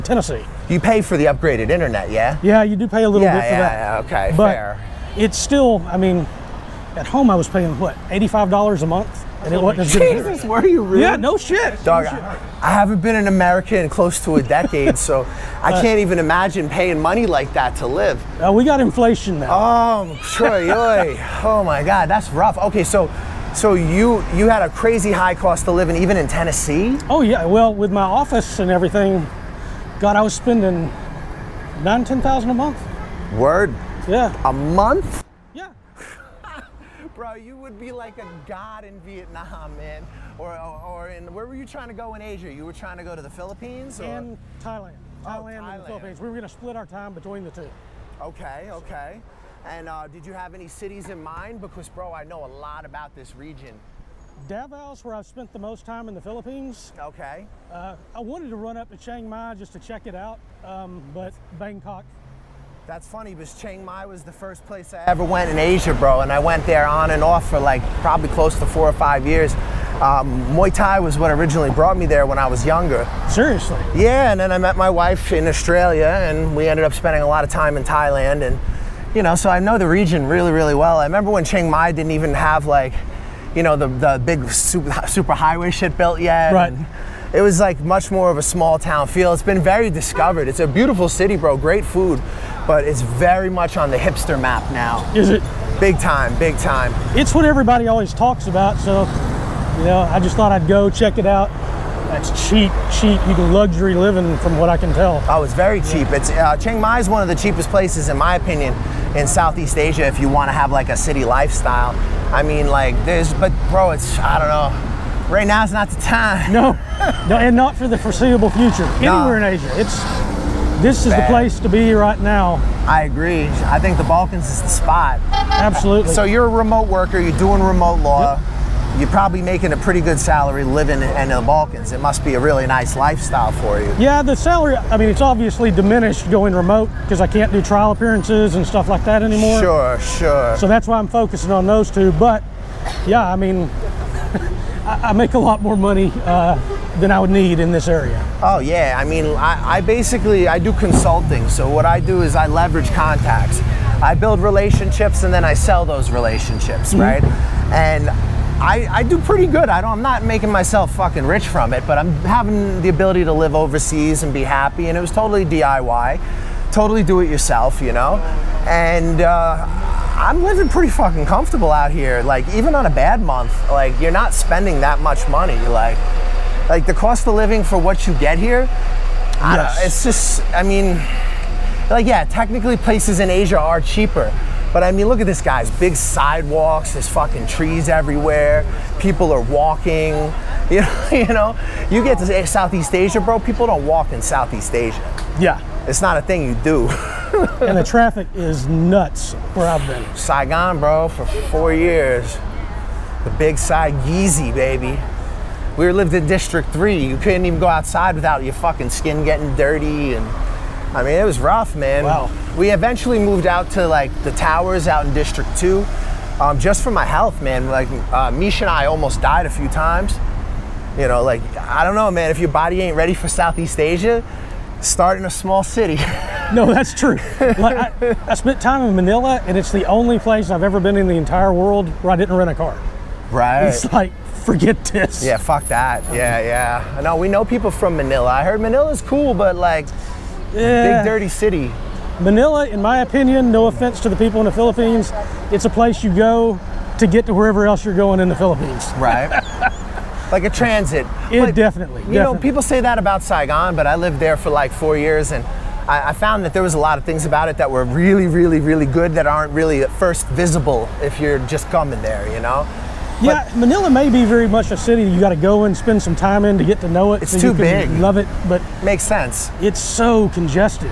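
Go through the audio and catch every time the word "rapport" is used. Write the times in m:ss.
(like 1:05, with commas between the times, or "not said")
not said.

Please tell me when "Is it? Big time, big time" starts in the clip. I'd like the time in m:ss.
1:35.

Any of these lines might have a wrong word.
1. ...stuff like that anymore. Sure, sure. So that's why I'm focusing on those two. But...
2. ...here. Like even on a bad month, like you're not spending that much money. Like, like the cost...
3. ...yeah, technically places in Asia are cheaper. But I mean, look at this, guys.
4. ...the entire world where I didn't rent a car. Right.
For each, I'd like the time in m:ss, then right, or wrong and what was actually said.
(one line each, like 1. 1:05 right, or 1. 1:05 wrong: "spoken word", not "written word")
1. 2:18 right
2. 2:51 right
3. 3:02 right
4. 3:51 right.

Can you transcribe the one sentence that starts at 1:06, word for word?
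And I went there on and off for like probably close to four or five years.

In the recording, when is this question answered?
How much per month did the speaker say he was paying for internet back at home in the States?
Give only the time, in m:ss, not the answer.
0:08.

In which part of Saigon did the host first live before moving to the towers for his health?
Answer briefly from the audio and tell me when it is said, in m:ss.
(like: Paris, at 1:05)
District 3, at 3:26.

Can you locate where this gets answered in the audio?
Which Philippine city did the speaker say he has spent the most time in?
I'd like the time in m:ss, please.
0:54.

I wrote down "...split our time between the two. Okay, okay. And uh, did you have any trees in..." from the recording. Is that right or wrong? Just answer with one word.
wrong.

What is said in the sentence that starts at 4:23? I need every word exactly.
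Yeah, Manila may be very much a city you got to go and spend some time in to get to know it.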